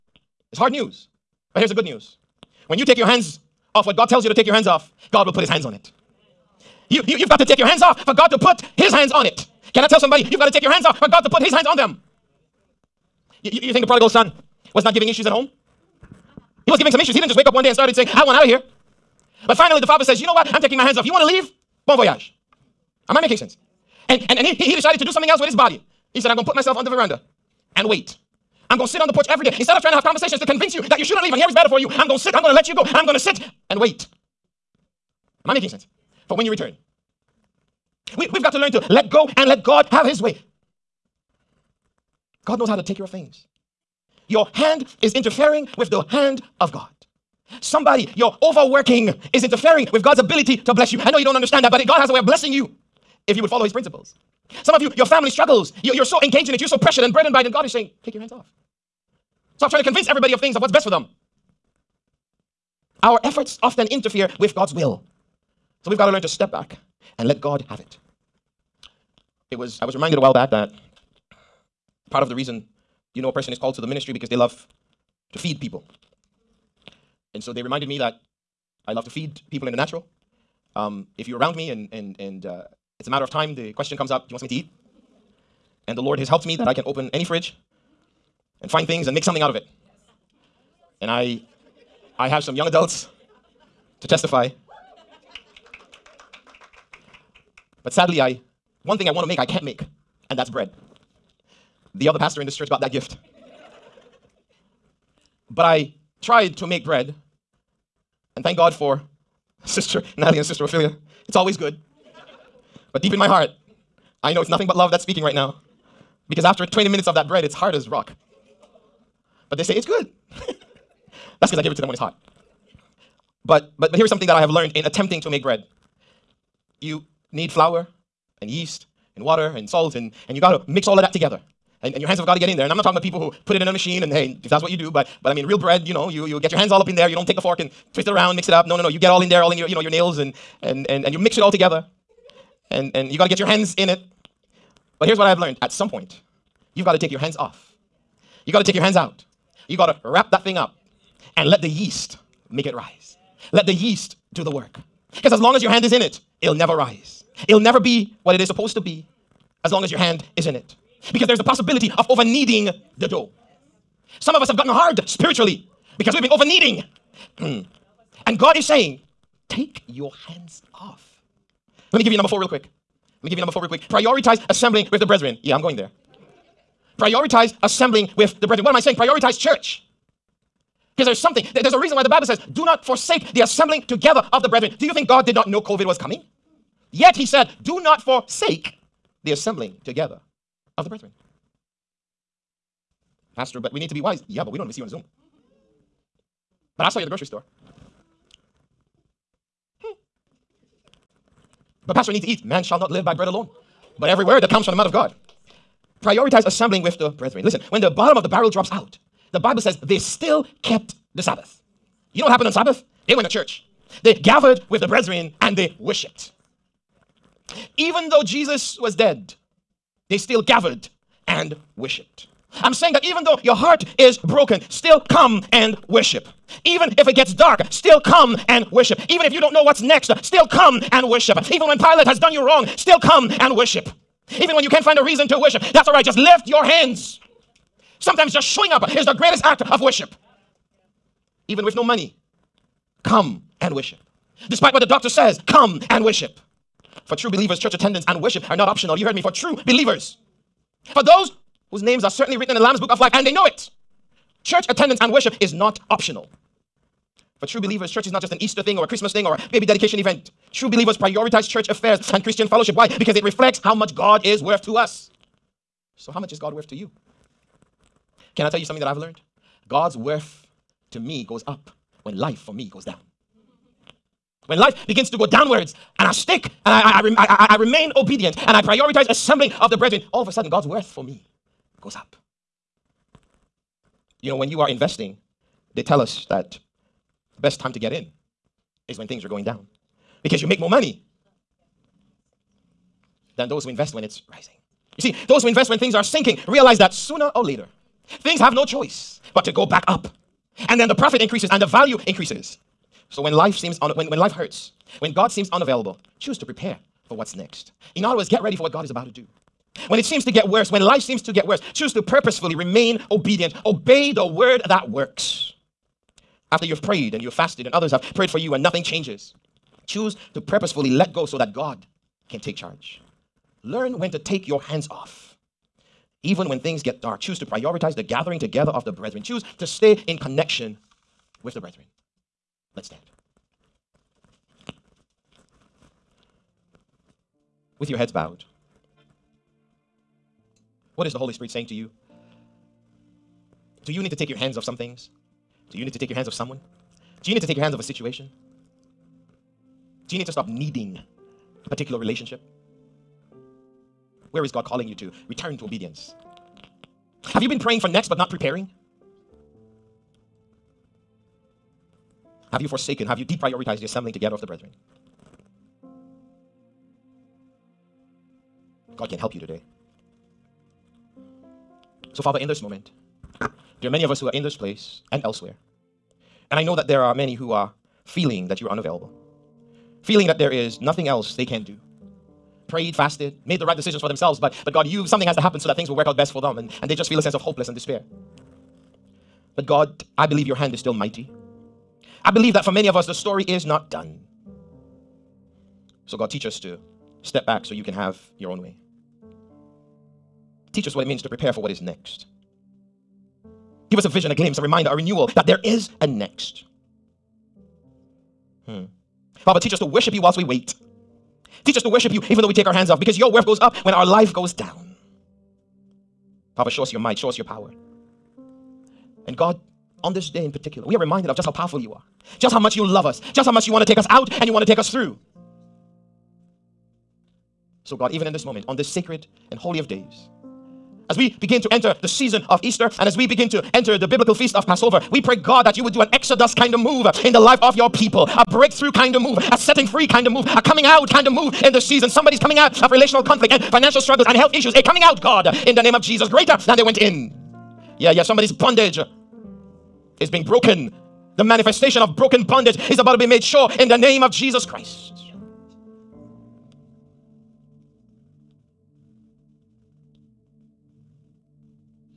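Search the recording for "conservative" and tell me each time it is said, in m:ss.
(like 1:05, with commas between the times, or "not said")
not said.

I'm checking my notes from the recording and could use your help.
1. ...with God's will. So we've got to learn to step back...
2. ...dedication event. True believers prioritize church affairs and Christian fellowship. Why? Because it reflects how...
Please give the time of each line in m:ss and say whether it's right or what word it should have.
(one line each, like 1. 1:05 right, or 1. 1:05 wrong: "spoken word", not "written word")
1. 1:04 right
2. 4:19 right.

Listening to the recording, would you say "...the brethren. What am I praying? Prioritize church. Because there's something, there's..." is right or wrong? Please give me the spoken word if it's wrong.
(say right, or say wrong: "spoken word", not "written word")
wrong: "saying", not "praying".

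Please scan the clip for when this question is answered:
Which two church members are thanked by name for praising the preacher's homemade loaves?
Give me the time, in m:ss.
1:49.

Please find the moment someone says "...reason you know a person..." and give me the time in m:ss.
1:12.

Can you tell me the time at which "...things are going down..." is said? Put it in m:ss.
4:49.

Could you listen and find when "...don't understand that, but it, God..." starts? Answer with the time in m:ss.
0:51.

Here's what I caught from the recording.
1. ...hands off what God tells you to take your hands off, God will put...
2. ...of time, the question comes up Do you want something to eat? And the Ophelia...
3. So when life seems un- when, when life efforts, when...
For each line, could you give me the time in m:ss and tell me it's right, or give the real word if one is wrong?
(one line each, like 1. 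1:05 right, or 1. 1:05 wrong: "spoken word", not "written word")
1. 0:03 right
2. 1:23 wrong: "Lord", not "Ophelia"
3. 5:03 wrong: "hurts", not "efforts".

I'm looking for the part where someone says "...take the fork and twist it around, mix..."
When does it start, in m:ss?
2:17.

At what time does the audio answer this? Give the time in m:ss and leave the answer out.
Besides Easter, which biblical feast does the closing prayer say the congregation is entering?
7:14.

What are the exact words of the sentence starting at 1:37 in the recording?
But sadly, I one thing I want to make I can't make, and that's bread.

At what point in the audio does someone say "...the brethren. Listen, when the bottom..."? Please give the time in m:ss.
3:26.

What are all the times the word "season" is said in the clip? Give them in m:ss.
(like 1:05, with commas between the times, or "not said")
7:12, 7:21.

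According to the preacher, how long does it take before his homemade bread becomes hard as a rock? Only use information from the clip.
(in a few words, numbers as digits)
20 minutes.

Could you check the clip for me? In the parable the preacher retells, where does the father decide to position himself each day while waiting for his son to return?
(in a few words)
On the veranda.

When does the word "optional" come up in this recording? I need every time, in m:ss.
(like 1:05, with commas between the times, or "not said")
4:08, 4:15.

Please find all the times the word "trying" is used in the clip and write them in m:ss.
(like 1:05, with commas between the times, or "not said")
0:29, 0:59.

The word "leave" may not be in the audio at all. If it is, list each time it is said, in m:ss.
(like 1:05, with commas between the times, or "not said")
0:21, 0:31.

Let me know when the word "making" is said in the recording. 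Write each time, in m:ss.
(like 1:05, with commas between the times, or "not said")
0:23, 0:35.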